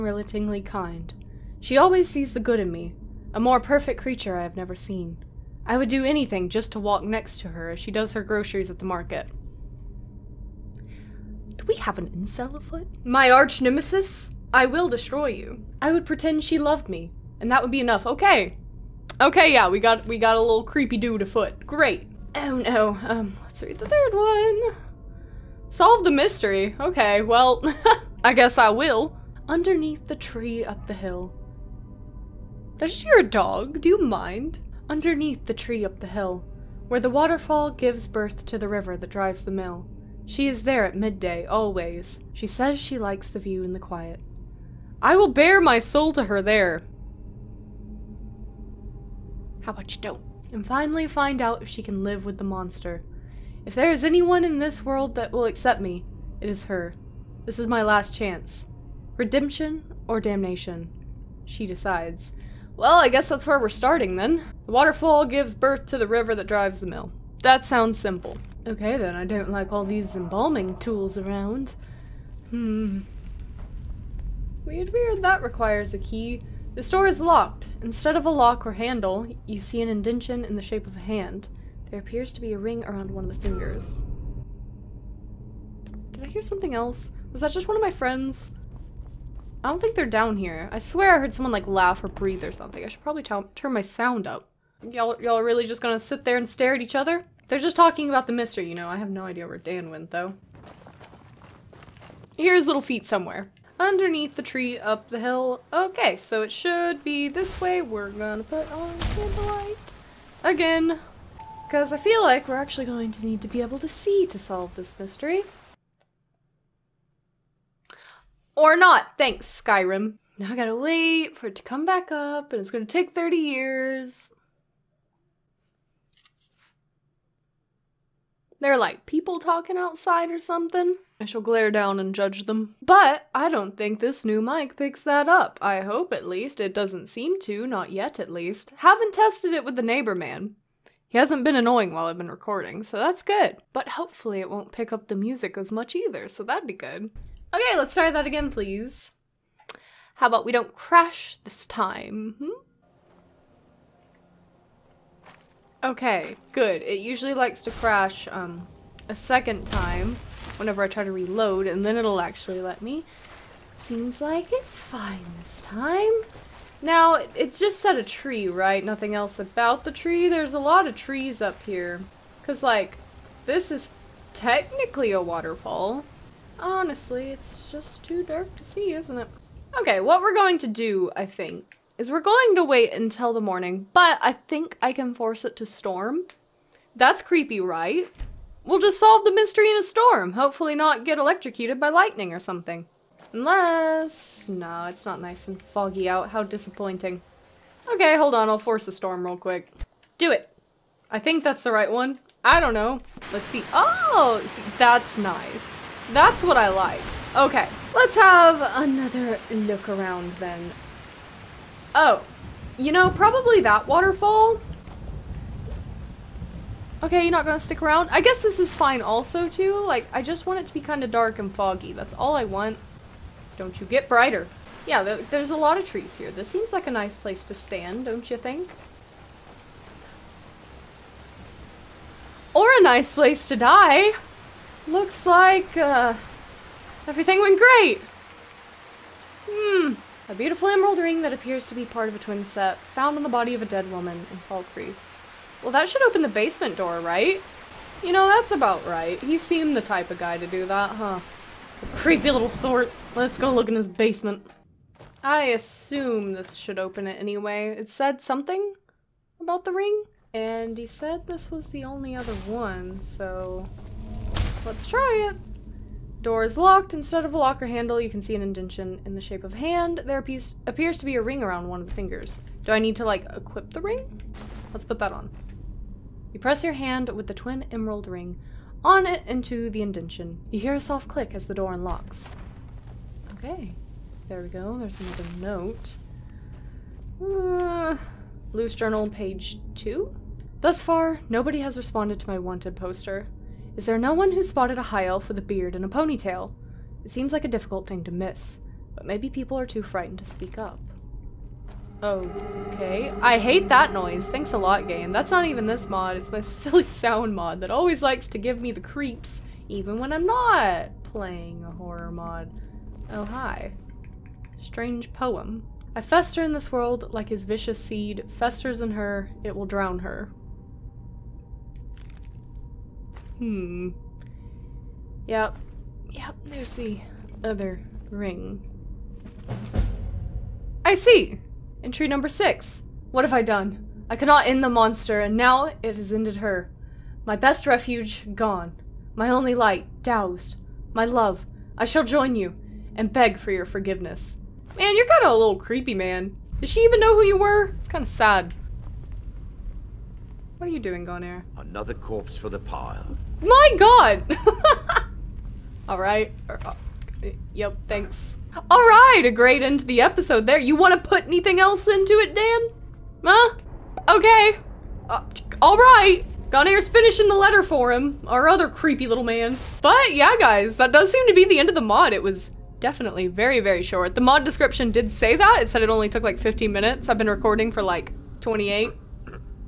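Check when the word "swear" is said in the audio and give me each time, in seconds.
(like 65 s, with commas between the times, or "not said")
90 s.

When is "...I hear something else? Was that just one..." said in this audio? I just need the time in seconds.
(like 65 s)
86 s.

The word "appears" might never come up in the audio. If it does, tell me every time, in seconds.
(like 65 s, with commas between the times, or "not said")
81 s, 241 s, 270 s.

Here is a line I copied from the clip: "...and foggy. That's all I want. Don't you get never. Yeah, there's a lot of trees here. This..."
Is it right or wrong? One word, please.
wrong.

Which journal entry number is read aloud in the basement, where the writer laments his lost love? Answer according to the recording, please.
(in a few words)
6.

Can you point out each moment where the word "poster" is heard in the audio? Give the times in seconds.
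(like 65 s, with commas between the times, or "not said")
292 s.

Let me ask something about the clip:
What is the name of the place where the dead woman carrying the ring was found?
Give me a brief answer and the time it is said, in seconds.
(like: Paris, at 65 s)
Fall Creek, at 244 s.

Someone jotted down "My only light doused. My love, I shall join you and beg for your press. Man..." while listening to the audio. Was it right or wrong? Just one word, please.
wrong.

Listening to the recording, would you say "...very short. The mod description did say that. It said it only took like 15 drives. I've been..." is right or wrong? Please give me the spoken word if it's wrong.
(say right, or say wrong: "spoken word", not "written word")
wrong: "minutes", not "drives".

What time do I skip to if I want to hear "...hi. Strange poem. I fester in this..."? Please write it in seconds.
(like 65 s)
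313 s.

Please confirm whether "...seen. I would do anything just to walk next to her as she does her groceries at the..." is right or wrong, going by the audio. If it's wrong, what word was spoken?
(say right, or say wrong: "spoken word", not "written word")
right.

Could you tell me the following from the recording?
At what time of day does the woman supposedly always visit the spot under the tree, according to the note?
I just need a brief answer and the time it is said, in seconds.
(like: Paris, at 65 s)
Midday, at 40 s.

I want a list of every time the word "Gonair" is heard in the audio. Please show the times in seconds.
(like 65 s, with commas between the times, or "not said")
351 s, 366 s.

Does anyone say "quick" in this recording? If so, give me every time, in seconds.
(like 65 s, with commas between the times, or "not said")
199 s.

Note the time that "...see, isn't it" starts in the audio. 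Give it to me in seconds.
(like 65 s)
178 s.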